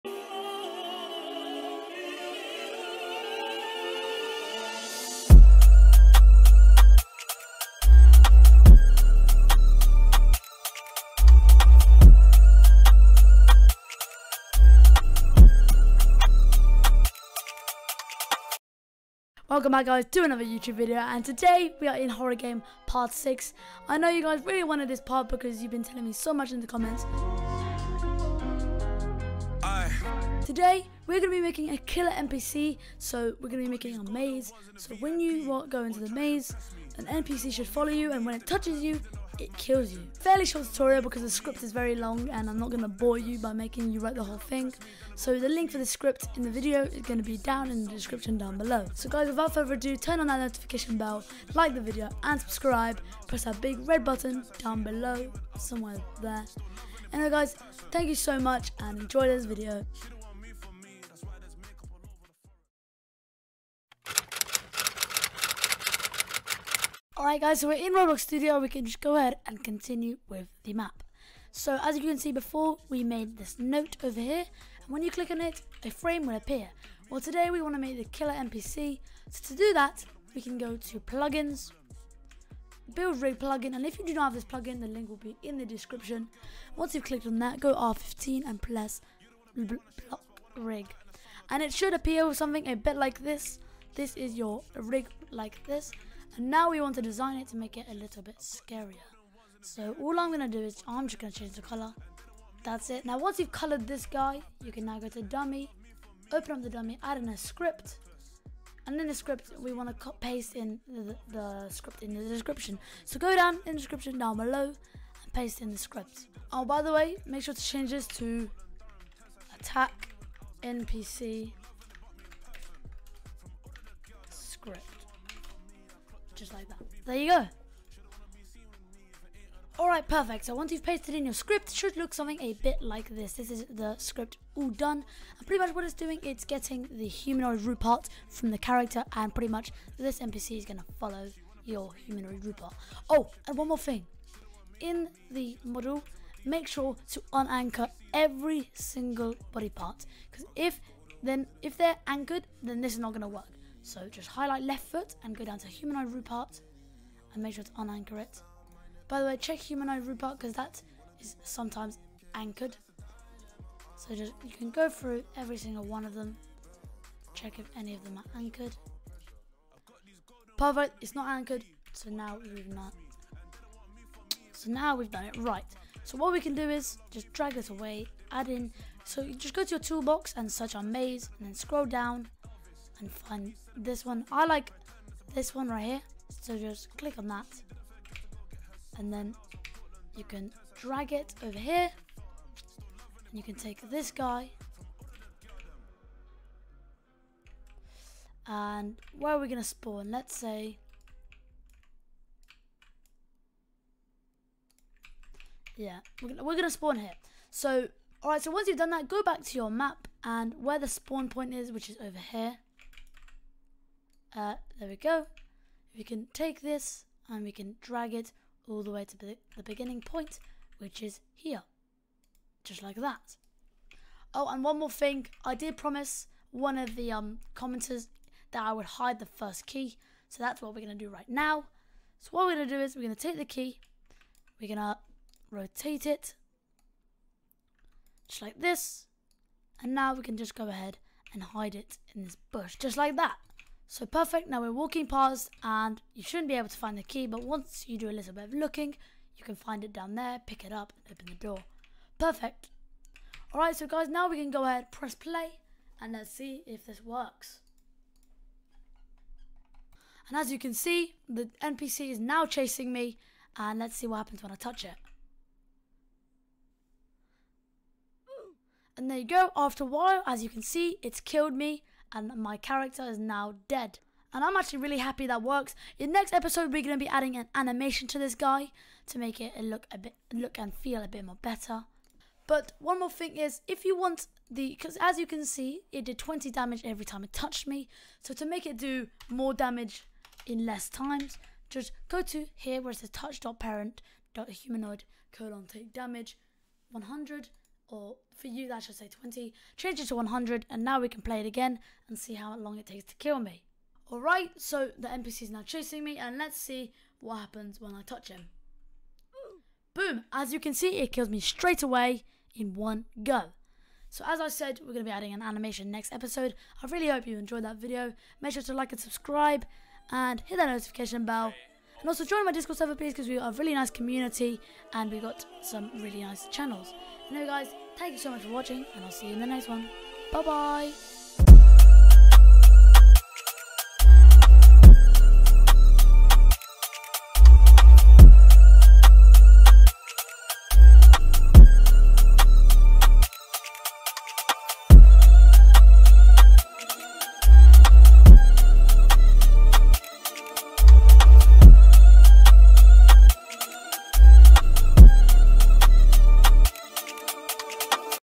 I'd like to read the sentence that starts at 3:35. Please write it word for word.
We can take this and we can drag it all the way to the beginning point, which is here.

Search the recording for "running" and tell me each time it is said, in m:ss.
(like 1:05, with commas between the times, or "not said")
not said.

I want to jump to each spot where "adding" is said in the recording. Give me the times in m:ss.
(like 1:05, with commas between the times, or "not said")
4:37, 5:15.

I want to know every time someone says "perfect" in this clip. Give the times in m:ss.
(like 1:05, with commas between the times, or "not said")
2:10, 2:50, 4:04, 4:12.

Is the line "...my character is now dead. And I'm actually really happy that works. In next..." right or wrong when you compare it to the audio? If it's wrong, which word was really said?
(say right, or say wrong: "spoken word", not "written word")
right.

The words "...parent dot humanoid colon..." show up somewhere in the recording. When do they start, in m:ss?
4:53.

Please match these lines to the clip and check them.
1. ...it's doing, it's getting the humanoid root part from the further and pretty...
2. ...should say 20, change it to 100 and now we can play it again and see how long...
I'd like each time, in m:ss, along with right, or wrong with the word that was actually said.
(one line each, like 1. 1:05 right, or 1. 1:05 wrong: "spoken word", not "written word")
1. 2:15 wrong: "character", not "further"
2. 4:58 right.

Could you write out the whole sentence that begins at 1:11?
So as you can see before, we made this note over here, and when you click on it, a frame will appear.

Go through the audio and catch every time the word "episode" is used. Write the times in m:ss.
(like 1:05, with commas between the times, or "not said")
4:36, 5:16.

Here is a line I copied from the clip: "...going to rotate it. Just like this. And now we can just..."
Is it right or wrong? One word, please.
right.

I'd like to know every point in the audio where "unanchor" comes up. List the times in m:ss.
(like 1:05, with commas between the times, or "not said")
2:27, 2:37.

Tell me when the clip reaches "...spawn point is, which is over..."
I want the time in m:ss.
3:30.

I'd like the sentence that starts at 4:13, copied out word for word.
Alright, so guys, now we can go ahead, press play, and let's see if this works.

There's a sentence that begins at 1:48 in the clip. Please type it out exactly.
And in the script, we want to paste in the, the script in the description.